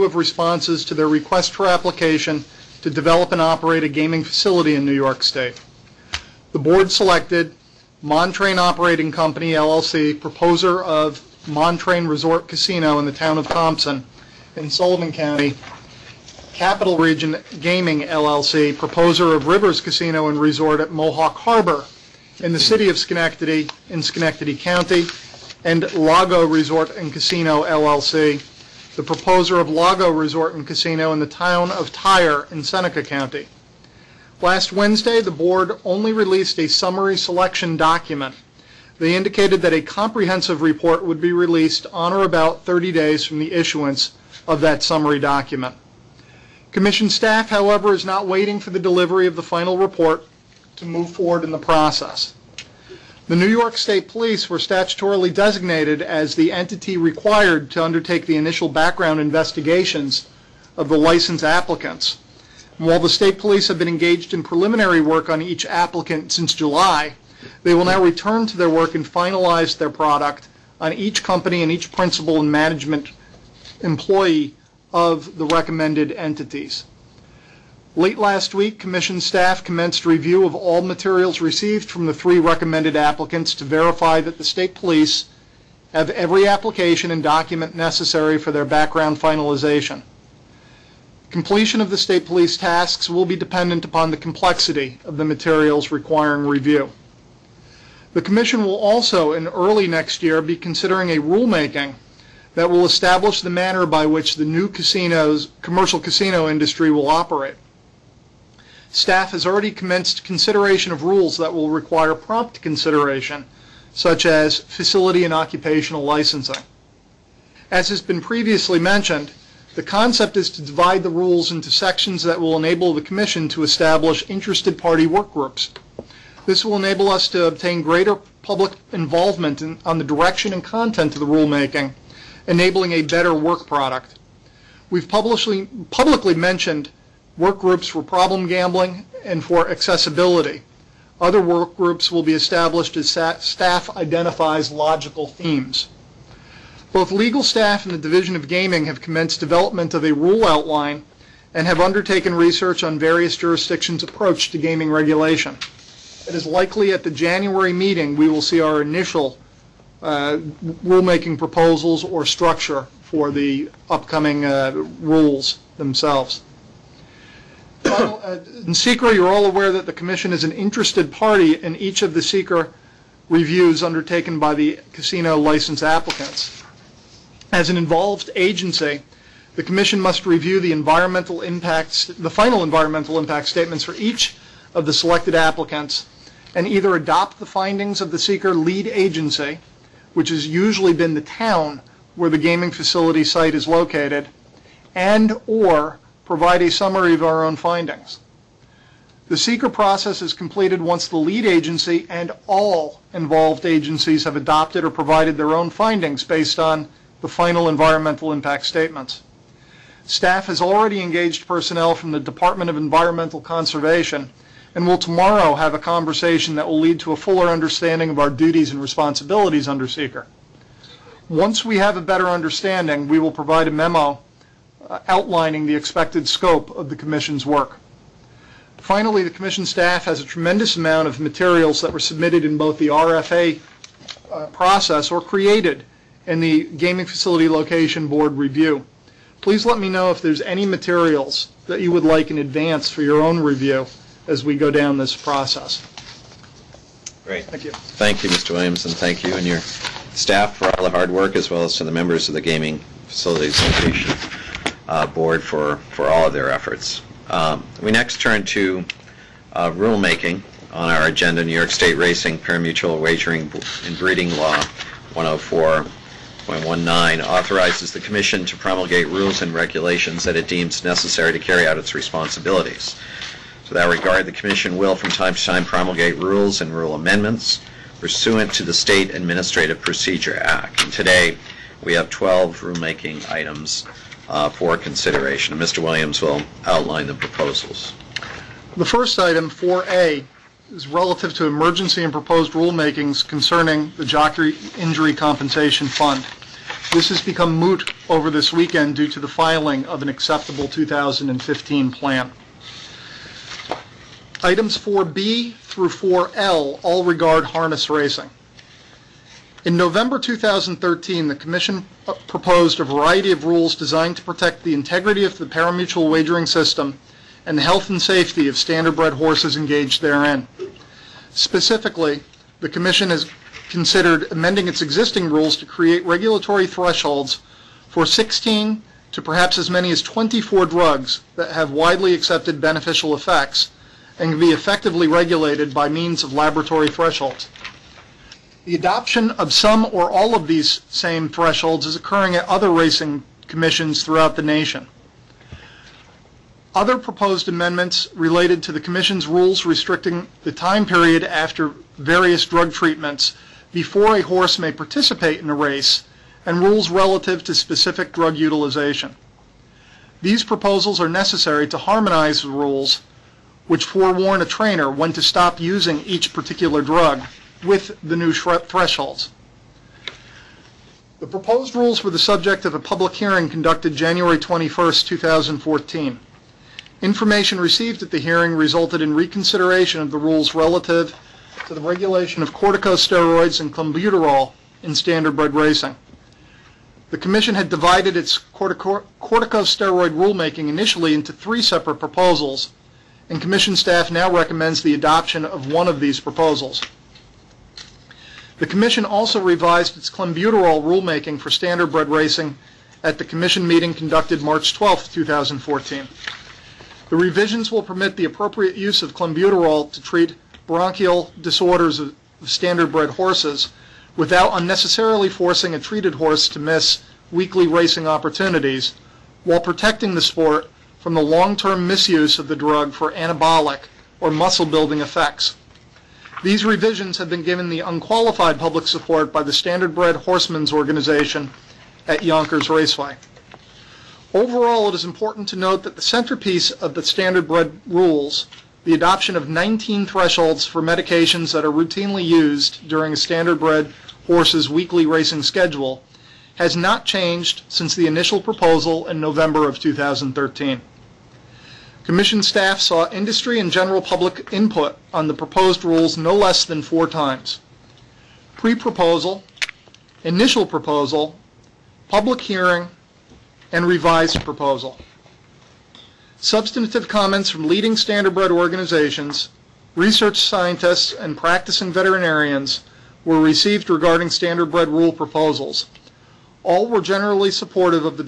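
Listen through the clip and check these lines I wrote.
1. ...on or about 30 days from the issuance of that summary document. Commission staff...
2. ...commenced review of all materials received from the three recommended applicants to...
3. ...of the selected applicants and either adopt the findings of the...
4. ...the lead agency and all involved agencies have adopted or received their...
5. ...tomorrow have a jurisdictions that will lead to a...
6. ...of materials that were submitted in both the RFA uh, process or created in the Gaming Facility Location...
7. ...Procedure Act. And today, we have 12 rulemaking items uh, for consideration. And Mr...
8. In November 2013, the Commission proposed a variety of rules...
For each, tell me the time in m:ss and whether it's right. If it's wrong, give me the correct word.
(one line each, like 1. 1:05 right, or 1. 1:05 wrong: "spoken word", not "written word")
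1. 0:41 right
2. 1:19 right
3. 3:04 right
4. 3:21 wrong: "provided", not "received"
5. 3:34 wrong: "conversation", not "jurisdictions"
6. 3:51 right
7. 4:39 right
8. 5:09 right.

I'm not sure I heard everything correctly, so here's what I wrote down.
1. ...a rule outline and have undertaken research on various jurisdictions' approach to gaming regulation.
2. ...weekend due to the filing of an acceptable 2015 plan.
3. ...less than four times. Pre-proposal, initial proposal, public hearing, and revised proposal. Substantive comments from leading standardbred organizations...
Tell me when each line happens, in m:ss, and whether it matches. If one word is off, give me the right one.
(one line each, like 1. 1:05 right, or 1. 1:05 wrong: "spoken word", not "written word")
1. 2:30 right
2. 4:58 right
3. 7:36 right.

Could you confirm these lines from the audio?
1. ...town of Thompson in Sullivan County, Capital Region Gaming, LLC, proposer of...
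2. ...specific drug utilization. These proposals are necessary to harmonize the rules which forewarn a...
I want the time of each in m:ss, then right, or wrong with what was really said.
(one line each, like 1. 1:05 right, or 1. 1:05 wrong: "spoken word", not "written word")
1. 0:13 right
2. 5:57 right.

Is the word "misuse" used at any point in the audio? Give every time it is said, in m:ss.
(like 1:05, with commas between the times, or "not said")
7:01.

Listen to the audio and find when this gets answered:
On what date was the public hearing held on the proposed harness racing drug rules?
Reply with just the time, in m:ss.
6:13.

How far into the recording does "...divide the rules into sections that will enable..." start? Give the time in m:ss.
2:00.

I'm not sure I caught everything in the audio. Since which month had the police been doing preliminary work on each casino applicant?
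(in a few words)
July.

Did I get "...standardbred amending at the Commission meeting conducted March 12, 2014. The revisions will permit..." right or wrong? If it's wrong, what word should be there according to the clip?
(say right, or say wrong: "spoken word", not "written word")
wrong: "racing", not "amending".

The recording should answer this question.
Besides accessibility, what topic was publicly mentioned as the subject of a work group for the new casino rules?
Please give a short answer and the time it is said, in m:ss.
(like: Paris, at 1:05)
problem gambling, at 2:18.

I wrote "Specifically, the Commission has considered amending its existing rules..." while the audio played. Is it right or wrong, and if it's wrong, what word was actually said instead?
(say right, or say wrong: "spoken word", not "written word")
right.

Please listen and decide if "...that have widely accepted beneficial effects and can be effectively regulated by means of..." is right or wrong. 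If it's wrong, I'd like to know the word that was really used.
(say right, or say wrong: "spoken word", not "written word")
right.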